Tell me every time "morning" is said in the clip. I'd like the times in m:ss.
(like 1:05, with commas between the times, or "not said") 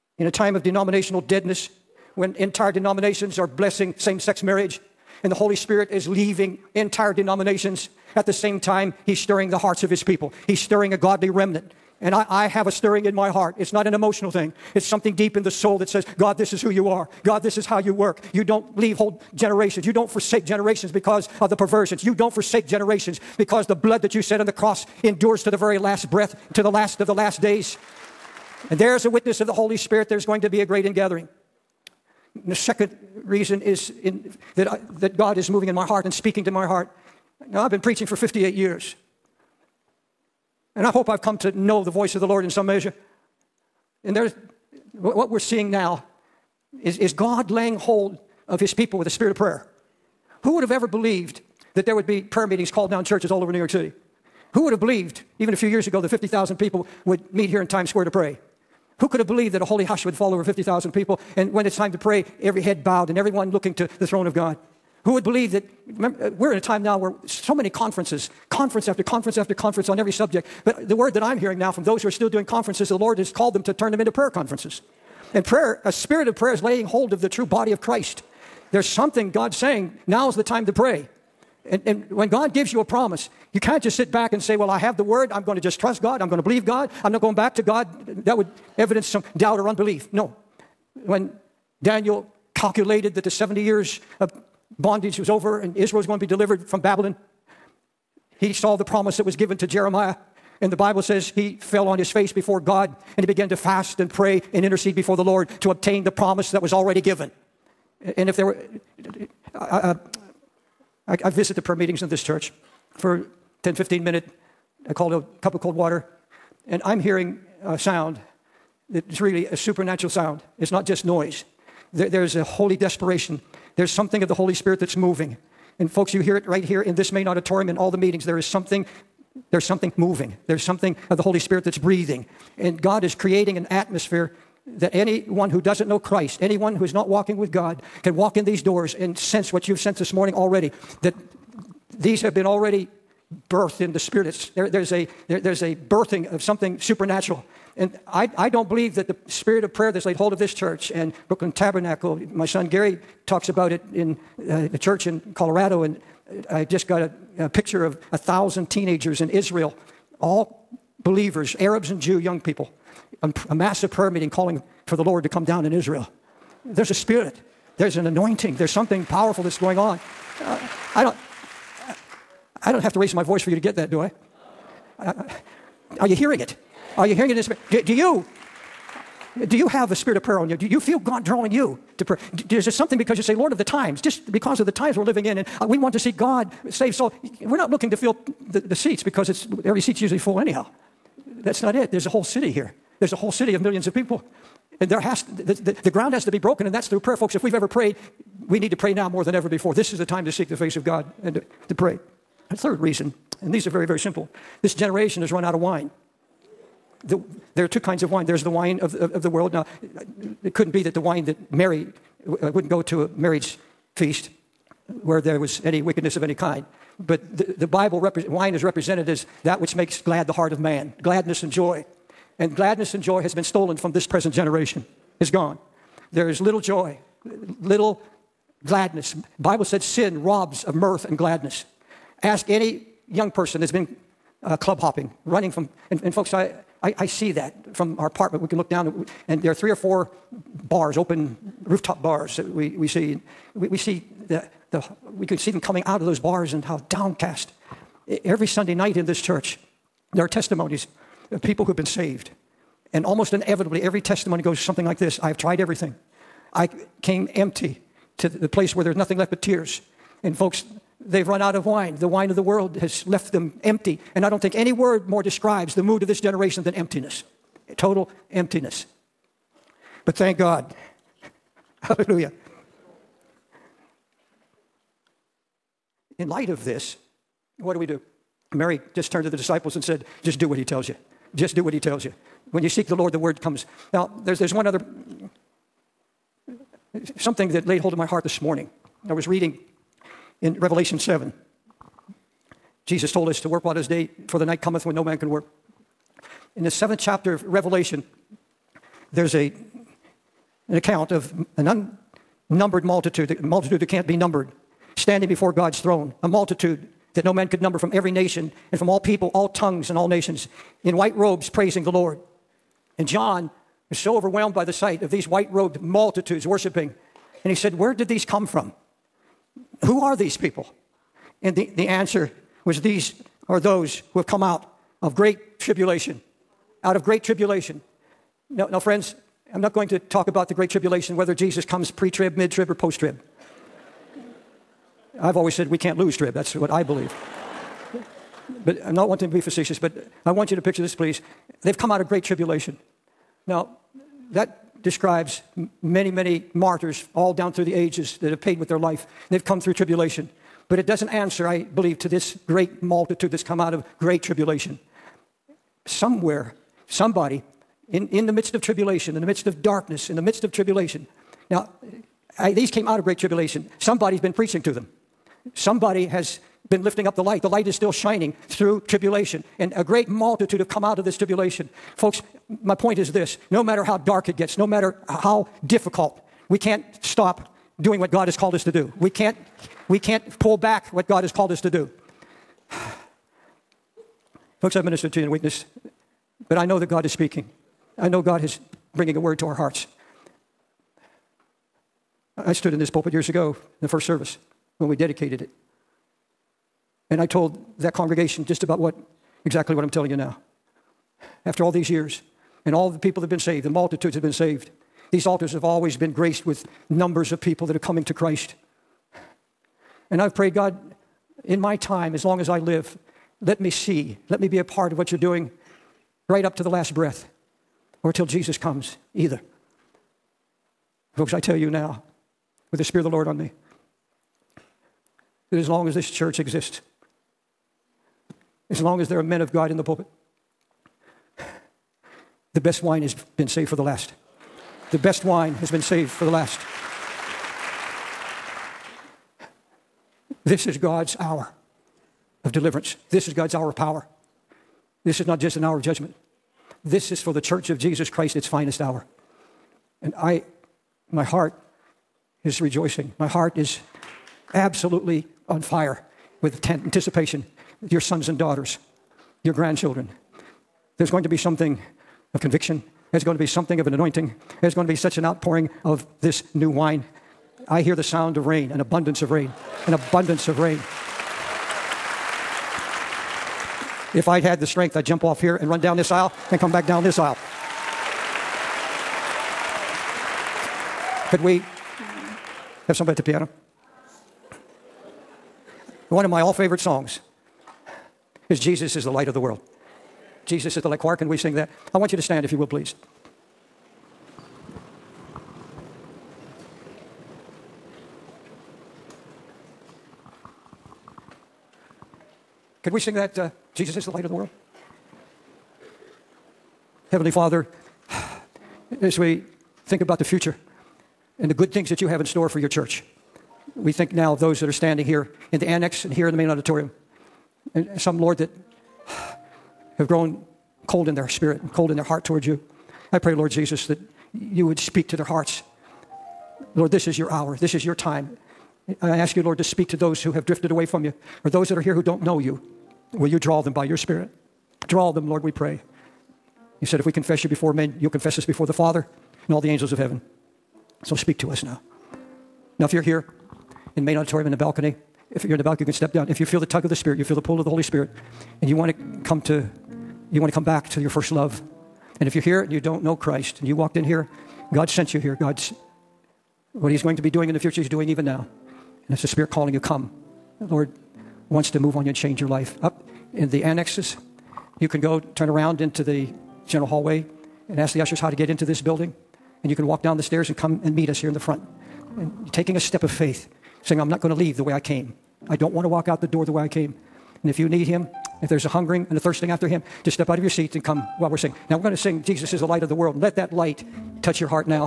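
2:20, 4:48.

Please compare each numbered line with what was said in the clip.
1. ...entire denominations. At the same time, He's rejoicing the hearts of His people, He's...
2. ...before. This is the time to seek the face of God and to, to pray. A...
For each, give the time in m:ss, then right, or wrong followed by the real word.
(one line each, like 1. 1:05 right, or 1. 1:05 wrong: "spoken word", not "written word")
1. 0:06 wrong: "stirring", not "rejoicing"
2. 3:19 right.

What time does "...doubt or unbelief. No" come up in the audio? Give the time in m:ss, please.
1:29.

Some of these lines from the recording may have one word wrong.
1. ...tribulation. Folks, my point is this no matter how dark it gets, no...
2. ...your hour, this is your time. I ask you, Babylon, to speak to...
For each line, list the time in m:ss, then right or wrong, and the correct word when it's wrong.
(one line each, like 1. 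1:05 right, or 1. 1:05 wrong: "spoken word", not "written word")
1. 6:11 right
2. 8:47 wrong: "Lord", not "Babylon".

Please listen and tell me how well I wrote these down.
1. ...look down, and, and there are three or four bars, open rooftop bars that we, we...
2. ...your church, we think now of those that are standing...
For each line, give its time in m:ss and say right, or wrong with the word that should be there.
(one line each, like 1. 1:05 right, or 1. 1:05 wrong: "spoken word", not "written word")
1. 3:58 right
2. 8:32 right.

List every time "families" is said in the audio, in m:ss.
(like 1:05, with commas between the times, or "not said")
not said.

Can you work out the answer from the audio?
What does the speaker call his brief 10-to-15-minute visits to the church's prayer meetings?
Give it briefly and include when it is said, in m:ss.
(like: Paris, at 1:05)
A cup of cold water, at 1:55.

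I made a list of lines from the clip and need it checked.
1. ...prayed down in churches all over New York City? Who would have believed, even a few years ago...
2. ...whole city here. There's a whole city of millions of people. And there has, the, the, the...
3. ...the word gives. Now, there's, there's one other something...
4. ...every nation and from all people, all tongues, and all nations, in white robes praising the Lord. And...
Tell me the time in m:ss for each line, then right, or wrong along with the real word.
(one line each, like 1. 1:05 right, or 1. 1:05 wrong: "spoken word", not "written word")
1. 0:52 wrong: "called", not "prayed"
2. 3:12 right
3. 4:43 wrong: "comes", not "gives"
4. 5:07 right.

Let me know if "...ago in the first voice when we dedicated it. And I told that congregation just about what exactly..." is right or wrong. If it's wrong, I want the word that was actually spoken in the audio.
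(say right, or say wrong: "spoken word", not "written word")
wrong: "service", not "voice".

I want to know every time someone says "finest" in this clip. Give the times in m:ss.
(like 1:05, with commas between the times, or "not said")
7:28.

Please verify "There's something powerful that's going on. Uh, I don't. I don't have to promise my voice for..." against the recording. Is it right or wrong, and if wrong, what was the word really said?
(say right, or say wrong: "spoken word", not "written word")
wrong: "raise", not "promise".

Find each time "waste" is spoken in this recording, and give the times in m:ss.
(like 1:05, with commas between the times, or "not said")
not said.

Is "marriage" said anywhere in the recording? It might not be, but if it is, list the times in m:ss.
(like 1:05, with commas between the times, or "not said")
0:04, 3:33.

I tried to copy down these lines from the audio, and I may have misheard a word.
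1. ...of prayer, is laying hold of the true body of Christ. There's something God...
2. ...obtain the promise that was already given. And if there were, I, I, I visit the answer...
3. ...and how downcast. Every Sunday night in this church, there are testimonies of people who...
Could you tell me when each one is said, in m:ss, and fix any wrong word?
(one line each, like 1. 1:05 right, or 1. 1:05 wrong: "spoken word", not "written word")
1. 1:16 right
2. 1:45 wrong: "prayer", not "answer"
3. 4:06 right.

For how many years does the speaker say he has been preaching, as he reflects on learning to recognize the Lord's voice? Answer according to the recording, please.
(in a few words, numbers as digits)
58.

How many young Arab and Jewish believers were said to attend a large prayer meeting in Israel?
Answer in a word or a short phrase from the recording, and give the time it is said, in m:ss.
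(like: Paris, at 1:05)
1,000, at 2:38.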